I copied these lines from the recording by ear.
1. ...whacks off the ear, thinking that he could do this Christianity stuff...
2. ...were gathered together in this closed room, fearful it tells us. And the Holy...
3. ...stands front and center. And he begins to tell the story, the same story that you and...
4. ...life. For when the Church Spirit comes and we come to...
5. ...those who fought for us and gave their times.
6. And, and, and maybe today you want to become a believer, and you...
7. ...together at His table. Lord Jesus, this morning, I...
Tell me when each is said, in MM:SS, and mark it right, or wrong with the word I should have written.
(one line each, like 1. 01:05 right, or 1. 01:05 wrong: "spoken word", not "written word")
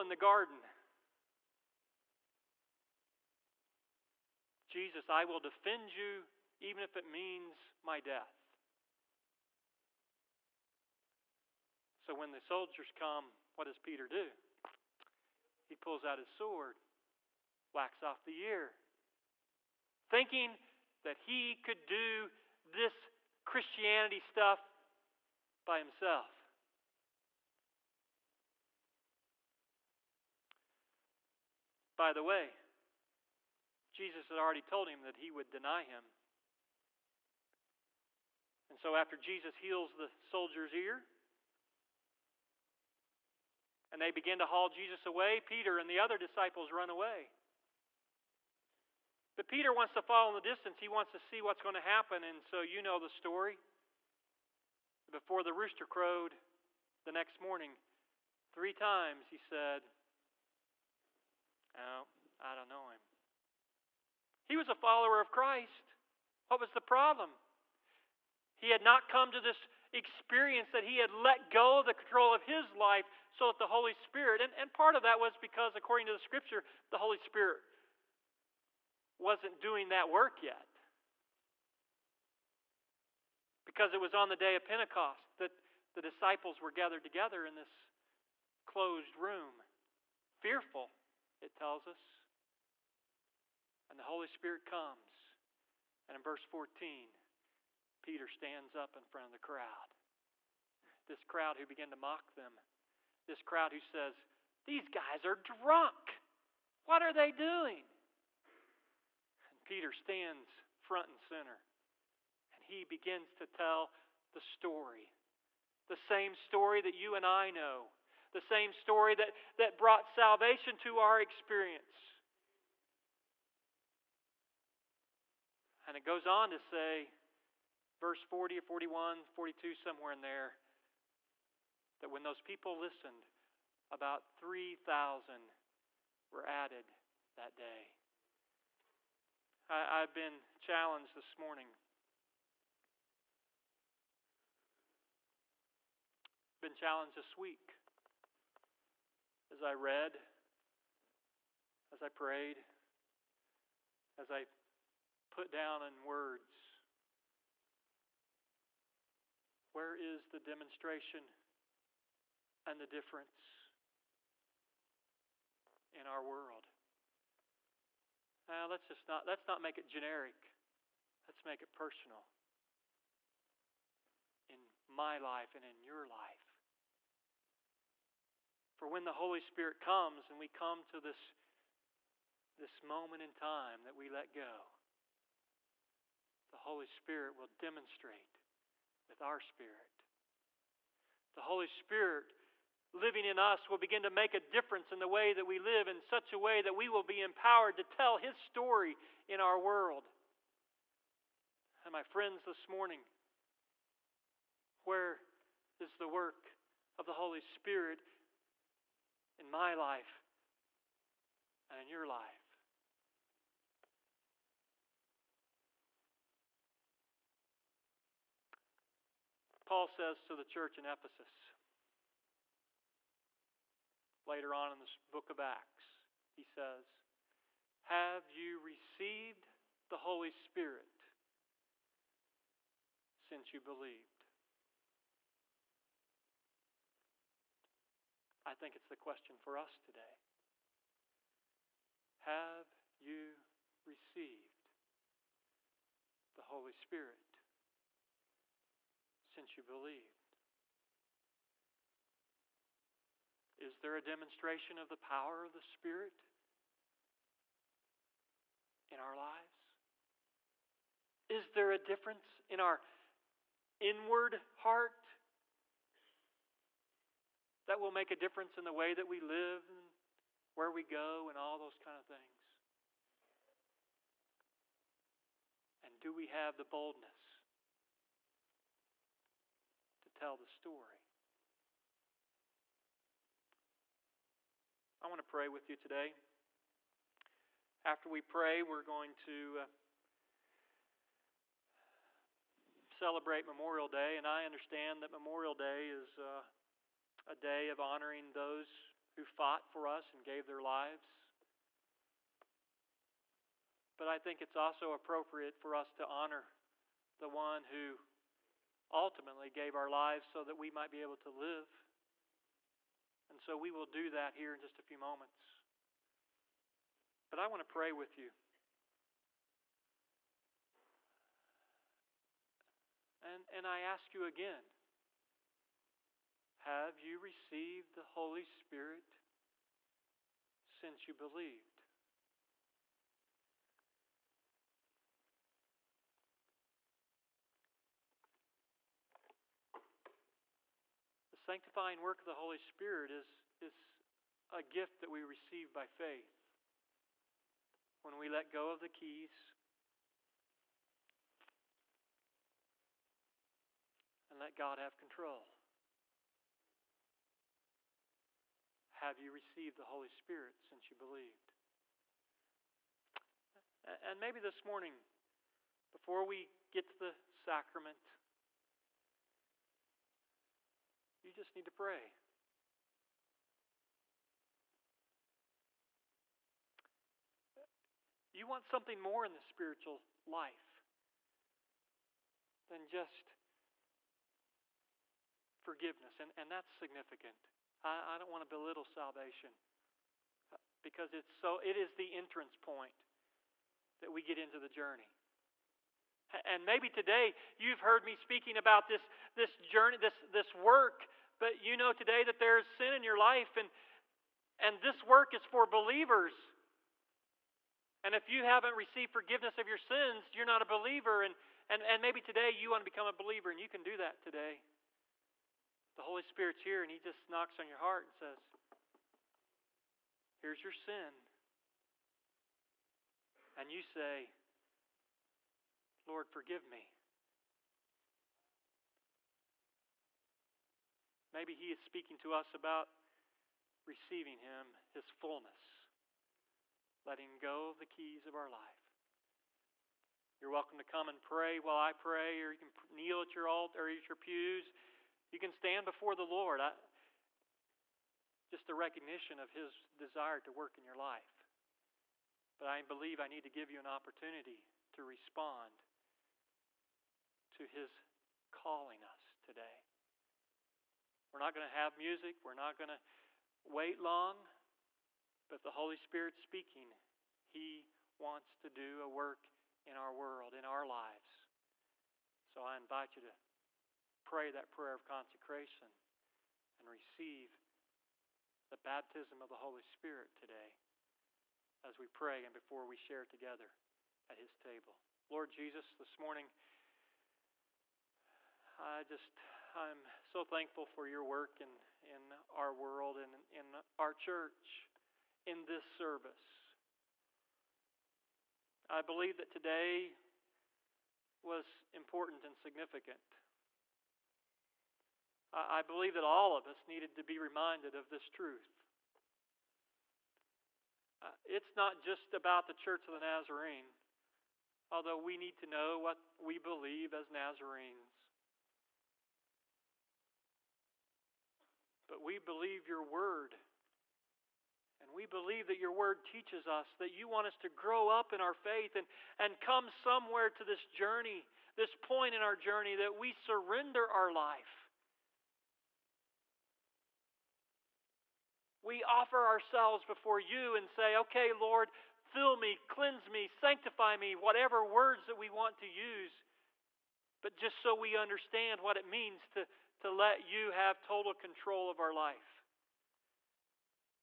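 1. 00:17 right
2. 01:26 right
3. 01:49 right
4. 02:56 wrong: "Holy", not "Church"
5. 04:58 wrong: "lives", not "times"
6. 06:51 right
7. 08:03 right.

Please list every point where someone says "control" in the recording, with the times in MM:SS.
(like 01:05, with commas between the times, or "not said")
01:11, 05:54, 09:11.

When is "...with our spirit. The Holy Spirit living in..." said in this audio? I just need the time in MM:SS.
03:09.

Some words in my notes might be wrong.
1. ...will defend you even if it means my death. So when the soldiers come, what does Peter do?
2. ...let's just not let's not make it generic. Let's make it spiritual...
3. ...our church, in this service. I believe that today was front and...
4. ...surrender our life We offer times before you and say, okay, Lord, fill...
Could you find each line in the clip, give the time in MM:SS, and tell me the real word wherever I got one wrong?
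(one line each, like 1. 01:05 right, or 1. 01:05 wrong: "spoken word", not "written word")
1. 00:05 right
2. 02:48 wrong: "personal", not "spiritual"
3. 08:13 wrong: "important", not "front"
4. 08:53 wrong: "ourselves", not "times".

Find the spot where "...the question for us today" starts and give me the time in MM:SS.
03:58.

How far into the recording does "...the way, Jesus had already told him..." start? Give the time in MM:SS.
00:32.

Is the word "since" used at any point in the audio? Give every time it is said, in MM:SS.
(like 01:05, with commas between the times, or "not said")
03:53, 04:09, 05:30, 06:00.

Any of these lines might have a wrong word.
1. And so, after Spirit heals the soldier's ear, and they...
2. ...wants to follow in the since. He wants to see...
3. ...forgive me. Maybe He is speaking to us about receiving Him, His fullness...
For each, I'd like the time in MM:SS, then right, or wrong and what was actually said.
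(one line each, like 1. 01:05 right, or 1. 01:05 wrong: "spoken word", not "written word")
1. 00:38 wrong: "Jesus", not "Spirit"
2. 00:49 wrong: "distance", not "since"
3. 07:06 right.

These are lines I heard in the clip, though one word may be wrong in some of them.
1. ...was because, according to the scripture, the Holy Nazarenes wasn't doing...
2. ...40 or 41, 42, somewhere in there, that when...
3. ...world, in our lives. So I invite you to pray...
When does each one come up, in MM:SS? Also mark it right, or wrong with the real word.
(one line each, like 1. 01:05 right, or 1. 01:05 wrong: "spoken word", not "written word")
1. 01:15 wrong: "Spirit", not "Nazarenes"
2. 02:08 right
3. 07:50 right.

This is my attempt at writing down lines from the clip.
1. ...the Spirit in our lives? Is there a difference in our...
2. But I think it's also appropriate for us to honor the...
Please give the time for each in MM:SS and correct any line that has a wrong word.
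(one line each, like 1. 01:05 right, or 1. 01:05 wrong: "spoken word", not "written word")
1. 04:15 right
2. 05:03 right.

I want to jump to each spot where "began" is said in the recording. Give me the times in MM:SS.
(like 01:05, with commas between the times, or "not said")
01:41.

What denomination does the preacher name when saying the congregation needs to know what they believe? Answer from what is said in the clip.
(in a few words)
Church of the Nazarene.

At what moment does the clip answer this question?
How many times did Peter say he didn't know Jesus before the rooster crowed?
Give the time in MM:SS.
00:58.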